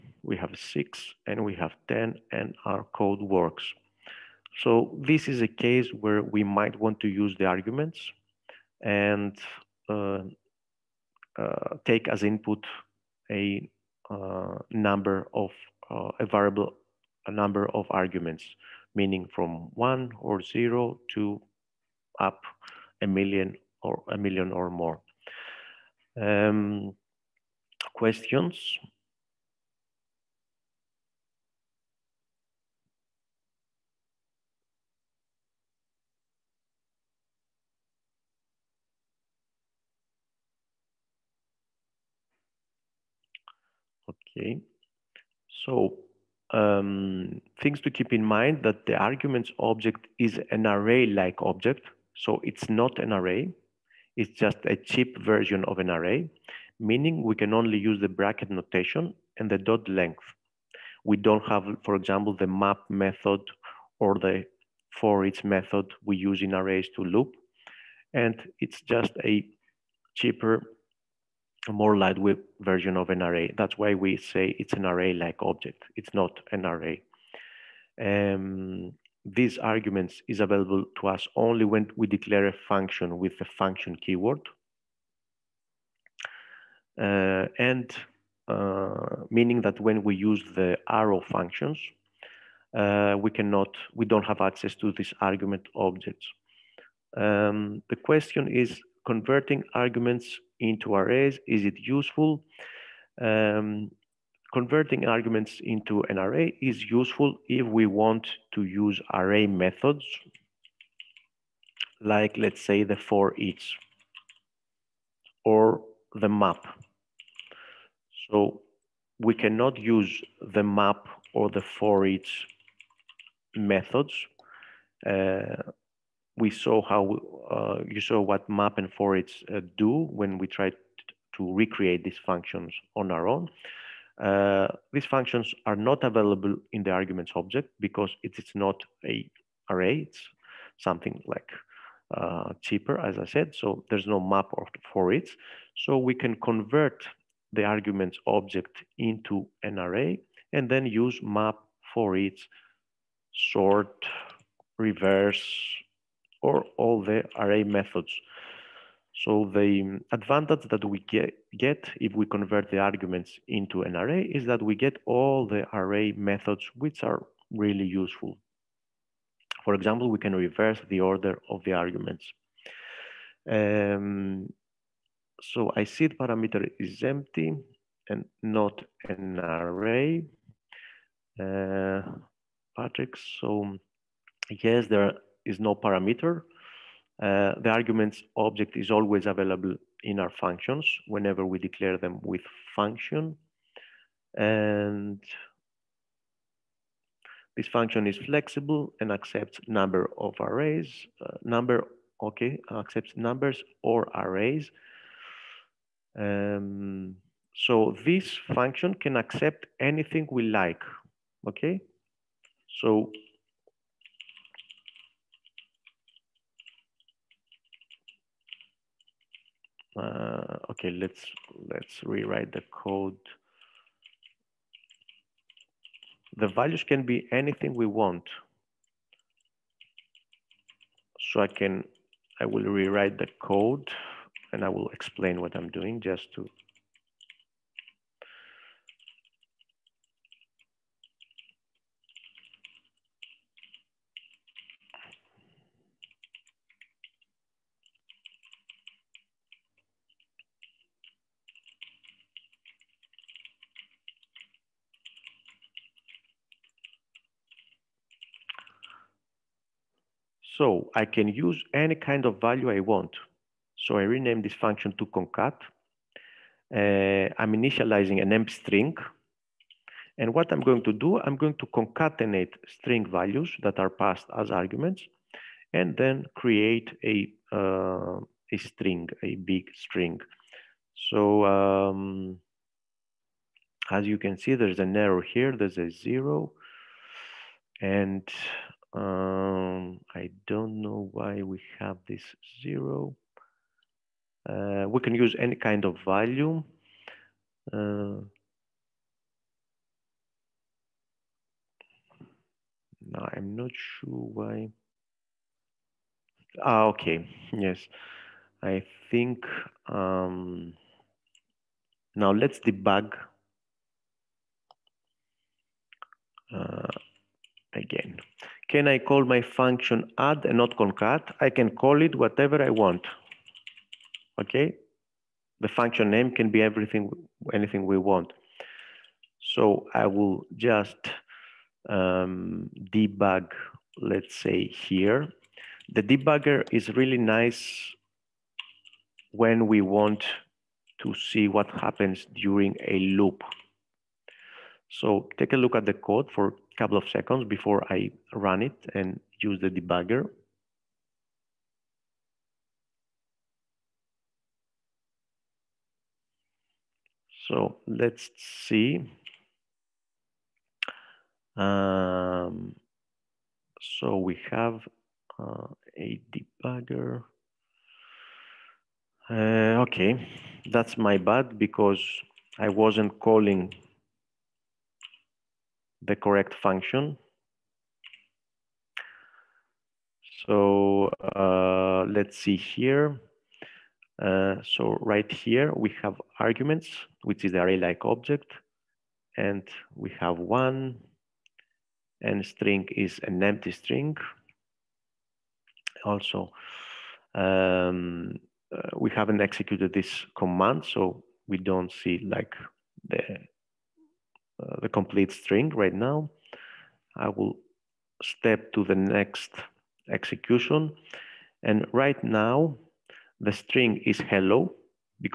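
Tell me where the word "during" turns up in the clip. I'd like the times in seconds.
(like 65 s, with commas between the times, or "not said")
342 s.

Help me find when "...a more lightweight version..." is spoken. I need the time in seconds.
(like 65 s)
71 s.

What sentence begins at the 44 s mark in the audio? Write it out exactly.
Okay, so um, things to keep in mind that the arguments object is an array-like object.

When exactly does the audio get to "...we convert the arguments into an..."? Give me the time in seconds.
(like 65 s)
162 s.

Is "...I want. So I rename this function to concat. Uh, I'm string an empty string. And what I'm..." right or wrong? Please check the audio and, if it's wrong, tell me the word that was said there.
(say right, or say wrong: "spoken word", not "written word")
wrong: "initializing", not "string".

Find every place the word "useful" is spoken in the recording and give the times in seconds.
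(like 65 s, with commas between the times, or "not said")
101 s, 106 s, 168 s.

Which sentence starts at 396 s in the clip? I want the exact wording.
Also, um, uh, we haven't executed this command, so we don't see like the uh, the complete string right now.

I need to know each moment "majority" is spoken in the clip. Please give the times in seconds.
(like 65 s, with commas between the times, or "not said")
not said.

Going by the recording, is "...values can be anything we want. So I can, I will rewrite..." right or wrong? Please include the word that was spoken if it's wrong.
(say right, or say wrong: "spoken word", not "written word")
right.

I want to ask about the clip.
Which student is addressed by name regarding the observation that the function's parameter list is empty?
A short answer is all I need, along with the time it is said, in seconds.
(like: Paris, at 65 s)
Patrick, at 182 s.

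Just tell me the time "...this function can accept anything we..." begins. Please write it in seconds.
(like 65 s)
208 s.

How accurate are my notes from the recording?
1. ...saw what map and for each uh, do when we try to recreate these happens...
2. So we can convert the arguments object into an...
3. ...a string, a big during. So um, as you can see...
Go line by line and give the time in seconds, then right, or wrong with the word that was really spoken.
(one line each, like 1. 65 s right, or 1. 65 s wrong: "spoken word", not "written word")
1. 127 s wrong: "functions", not "happens"
2. 145 s right
3. 278 s wrong: "string", not "during".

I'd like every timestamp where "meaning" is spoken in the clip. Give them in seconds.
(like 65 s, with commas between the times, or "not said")
18 s, 56 s, 89 s.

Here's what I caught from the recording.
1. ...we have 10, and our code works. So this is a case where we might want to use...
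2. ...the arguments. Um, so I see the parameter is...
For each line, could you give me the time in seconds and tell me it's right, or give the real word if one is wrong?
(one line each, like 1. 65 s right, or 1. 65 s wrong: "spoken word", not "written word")
1. 1 s right
2. 171 s right.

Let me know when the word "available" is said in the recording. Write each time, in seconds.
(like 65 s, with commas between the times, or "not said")
80 s, 136 s, 189 s.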